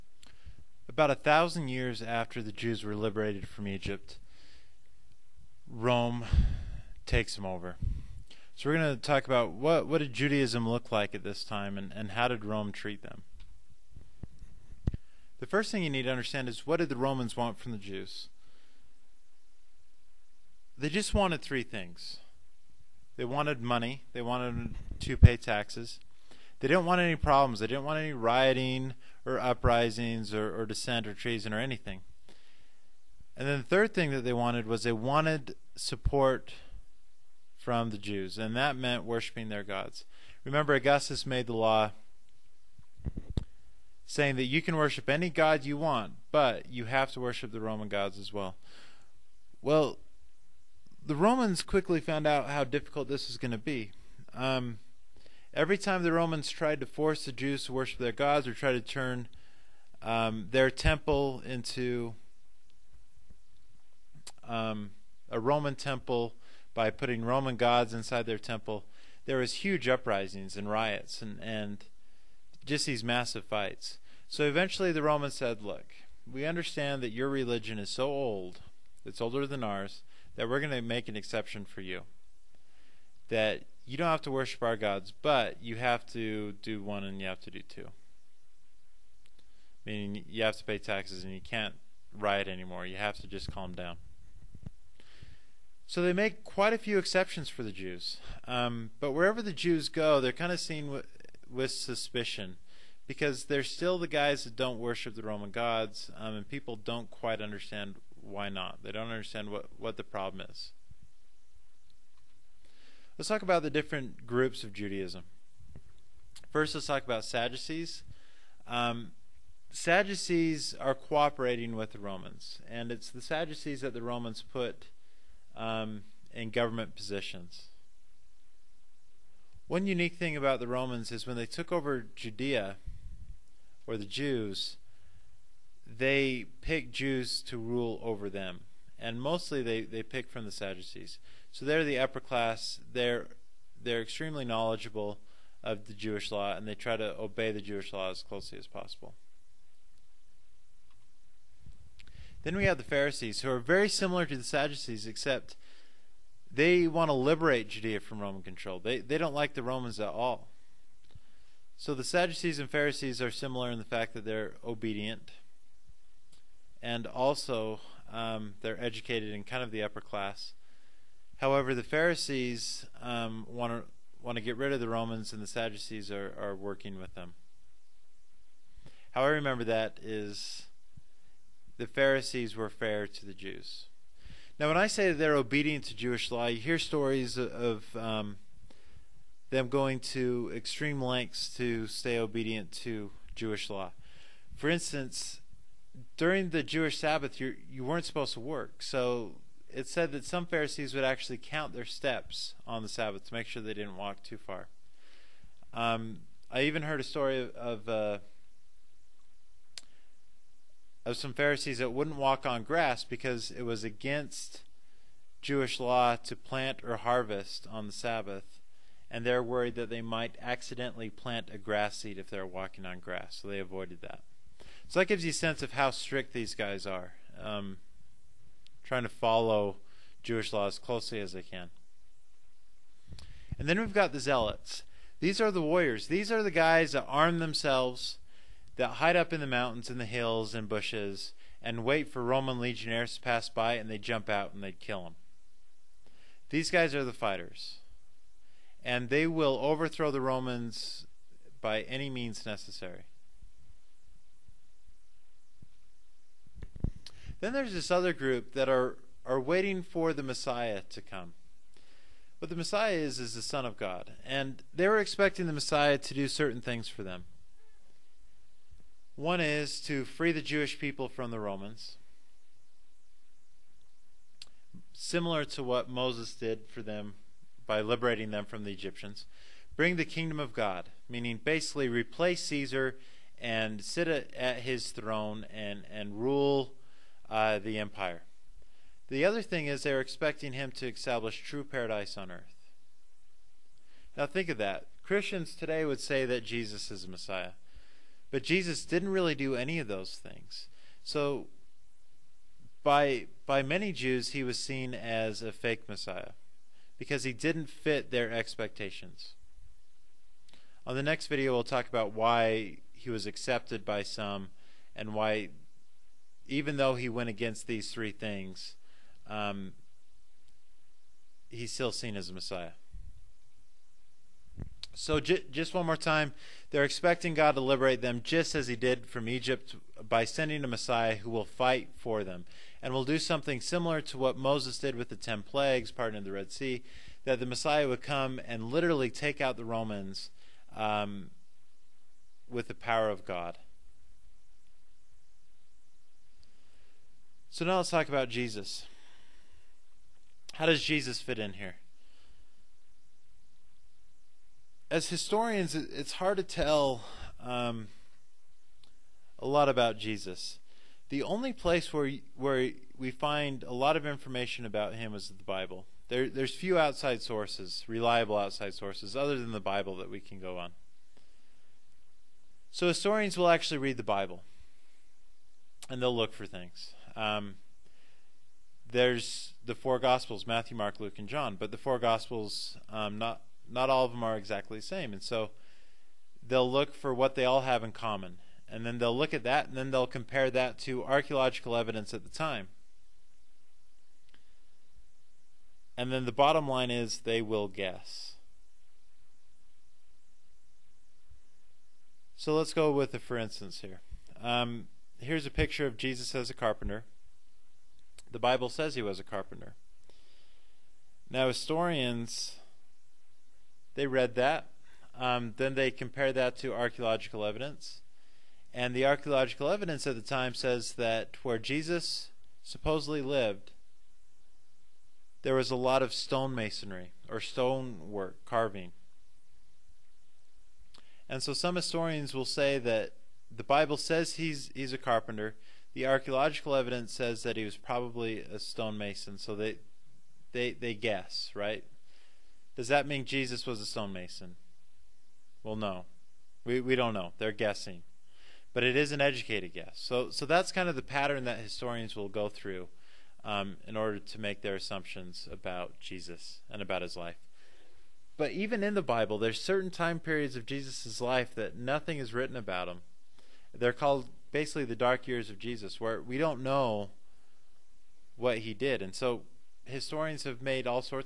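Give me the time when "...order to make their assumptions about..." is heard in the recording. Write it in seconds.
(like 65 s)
453 s.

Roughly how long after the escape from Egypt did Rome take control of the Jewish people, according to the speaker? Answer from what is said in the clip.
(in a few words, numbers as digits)
about 1000 years.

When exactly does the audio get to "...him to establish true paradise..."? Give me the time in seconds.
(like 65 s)
290 s.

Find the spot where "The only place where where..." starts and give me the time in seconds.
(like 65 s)
361 s.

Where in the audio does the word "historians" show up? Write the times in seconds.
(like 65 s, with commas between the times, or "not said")
355 s, 372 s, 411 s, 431 s, 451 s, 469 s.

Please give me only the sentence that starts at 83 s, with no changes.
That you don't have to worship our gods, but you have to do one and you have to do two.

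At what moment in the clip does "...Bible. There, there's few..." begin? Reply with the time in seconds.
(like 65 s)
365 s.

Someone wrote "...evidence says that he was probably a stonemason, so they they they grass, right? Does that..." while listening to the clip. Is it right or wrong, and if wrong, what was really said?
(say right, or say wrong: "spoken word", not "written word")
wrong: "guess", not "grass".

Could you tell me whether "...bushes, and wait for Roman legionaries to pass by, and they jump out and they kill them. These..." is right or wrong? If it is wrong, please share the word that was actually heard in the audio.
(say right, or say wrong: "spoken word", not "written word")
right.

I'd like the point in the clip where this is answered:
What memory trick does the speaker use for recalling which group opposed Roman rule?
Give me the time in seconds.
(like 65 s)
181 s.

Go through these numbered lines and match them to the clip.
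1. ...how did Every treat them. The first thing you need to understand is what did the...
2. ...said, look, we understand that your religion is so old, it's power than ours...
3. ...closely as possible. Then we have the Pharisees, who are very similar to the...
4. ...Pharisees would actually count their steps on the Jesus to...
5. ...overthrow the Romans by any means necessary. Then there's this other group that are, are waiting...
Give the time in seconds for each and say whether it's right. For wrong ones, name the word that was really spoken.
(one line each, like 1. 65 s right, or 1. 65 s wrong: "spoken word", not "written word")
1. 12 s wrong: "Rome", not "Every"
2. 75 s wrong: "older", not "power"
3. 148 s right
4. 200 s wrong: "Sabbath", not "Jesus"
5. 249 s right.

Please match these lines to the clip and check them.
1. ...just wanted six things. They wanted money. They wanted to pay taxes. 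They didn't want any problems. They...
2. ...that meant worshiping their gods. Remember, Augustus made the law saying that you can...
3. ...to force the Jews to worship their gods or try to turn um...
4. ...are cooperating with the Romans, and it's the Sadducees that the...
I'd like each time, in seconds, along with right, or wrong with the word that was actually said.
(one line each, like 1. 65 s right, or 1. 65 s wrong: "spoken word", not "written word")
1. 20 s wrong: "three", not "six"
2. 38 s right
3. 56 s right
4. 120 s right.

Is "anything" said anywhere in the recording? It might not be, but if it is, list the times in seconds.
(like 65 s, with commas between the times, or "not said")
31 s.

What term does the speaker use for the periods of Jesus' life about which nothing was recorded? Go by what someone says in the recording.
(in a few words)
the dark years.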